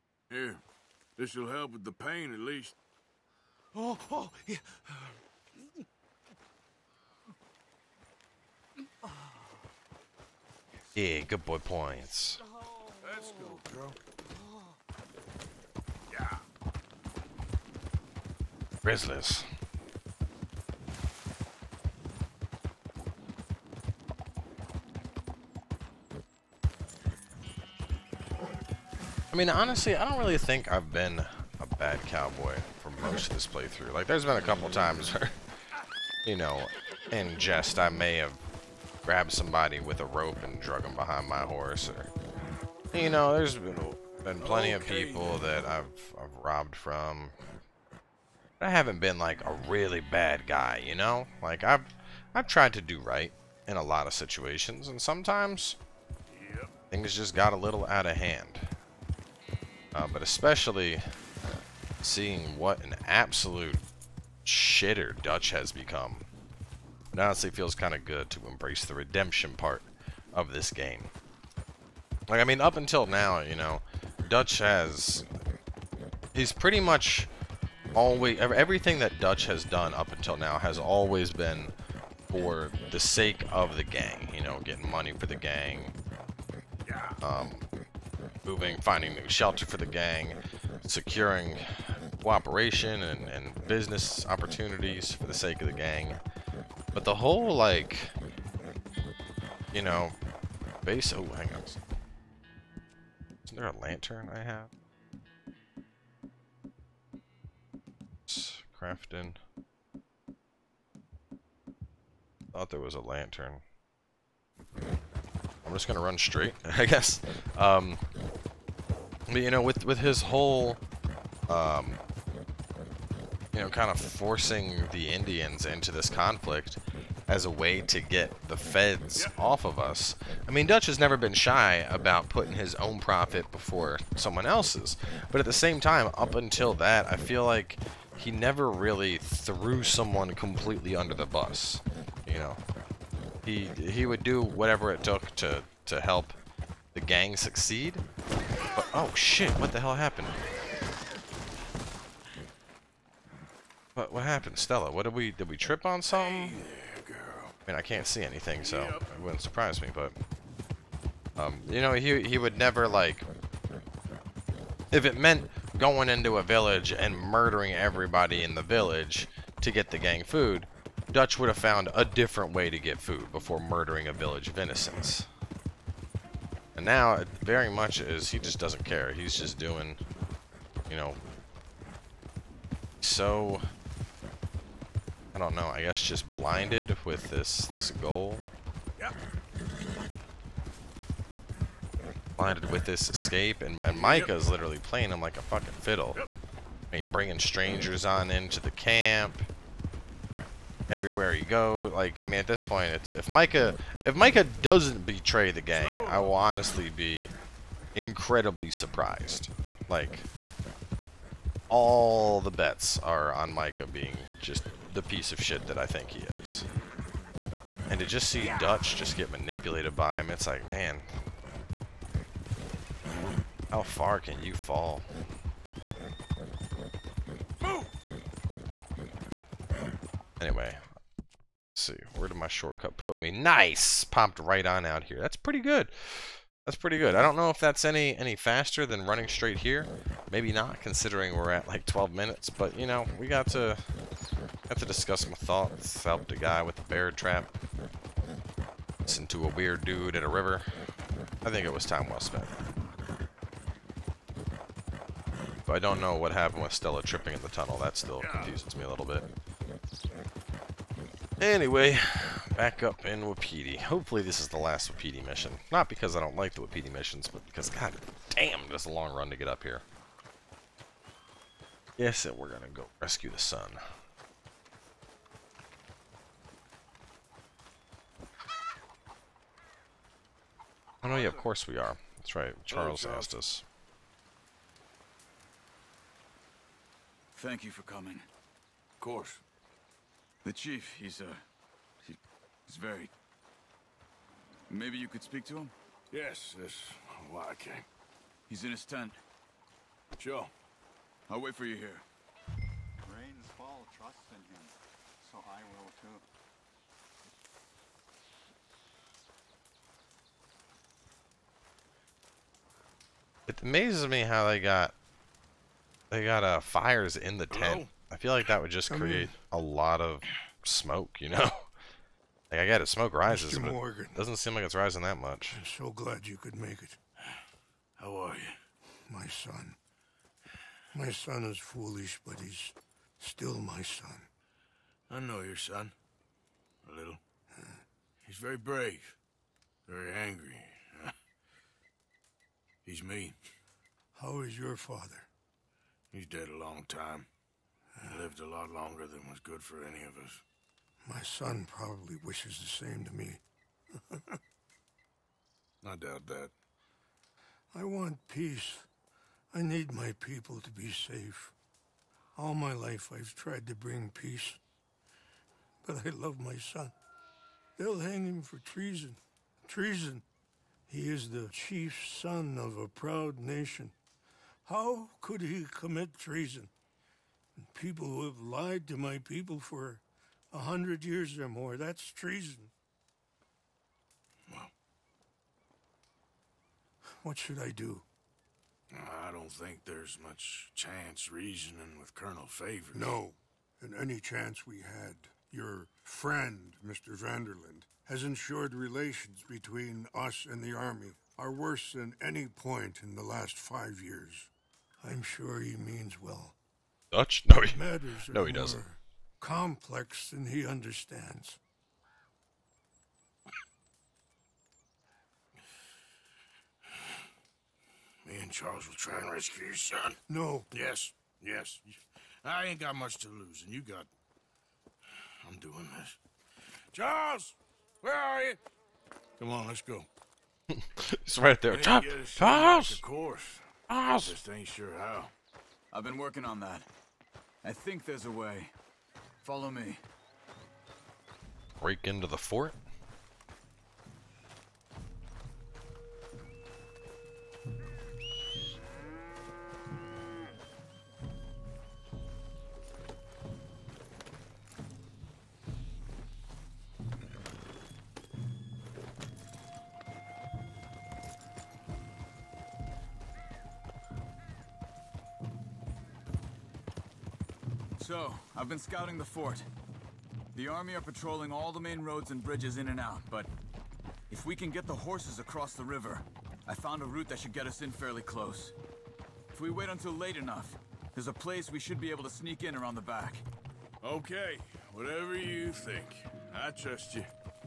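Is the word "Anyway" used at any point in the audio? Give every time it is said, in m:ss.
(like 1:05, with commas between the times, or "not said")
3:50, 4:21.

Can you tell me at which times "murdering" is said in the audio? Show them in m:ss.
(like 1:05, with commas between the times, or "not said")
2:47, 2:53.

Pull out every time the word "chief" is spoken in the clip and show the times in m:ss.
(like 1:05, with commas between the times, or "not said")
4:50, 6:11.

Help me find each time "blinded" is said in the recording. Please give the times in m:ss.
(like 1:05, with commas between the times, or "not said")
3:06, 3:12.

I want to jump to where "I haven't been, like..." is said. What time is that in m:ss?
0:48.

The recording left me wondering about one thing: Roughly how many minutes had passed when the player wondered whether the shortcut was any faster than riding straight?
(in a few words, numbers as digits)
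12.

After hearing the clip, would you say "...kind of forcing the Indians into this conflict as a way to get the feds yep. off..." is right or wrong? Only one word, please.
right.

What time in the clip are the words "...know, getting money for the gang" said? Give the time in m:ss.
1:24.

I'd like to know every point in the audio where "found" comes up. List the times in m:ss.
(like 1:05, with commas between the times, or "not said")
2:51, 7:56.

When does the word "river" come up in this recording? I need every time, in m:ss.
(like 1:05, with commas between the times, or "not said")
4:10, 7:55.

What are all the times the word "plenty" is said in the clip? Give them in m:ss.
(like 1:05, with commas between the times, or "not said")
0:44.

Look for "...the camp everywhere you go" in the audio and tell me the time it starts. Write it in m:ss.
3:18.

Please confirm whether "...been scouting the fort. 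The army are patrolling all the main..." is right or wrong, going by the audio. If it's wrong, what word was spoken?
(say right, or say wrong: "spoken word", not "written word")
right.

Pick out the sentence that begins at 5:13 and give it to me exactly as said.
It amazes me how they got they got uh, fires in the Hello?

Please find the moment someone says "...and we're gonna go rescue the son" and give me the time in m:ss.
4:32.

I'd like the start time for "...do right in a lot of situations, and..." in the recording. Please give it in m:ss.
0:52.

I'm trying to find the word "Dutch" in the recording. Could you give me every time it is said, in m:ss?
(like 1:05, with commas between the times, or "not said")
1:05, 1:14, 1:19, 2:10, 2:51, 3:38, 6:47.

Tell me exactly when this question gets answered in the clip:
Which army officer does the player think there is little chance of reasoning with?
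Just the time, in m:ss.
6:32.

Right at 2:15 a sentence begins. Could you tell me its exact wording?
But at the same time, up until that, I feel like he never really threw someone completely under the bus.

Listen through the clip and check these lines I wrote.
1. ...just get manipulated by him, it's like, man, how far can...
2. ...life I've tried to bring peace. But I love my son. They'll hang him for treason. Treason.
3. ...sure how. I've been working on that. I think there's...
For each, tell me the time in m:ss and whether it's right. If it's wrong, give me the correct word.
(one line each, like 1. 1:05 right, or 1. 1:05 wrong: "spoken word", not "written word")
1. 3:38 right
2. 6:02 right
3. 7:14 right.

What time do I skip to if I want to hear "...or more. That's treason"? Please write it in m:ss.
6:21.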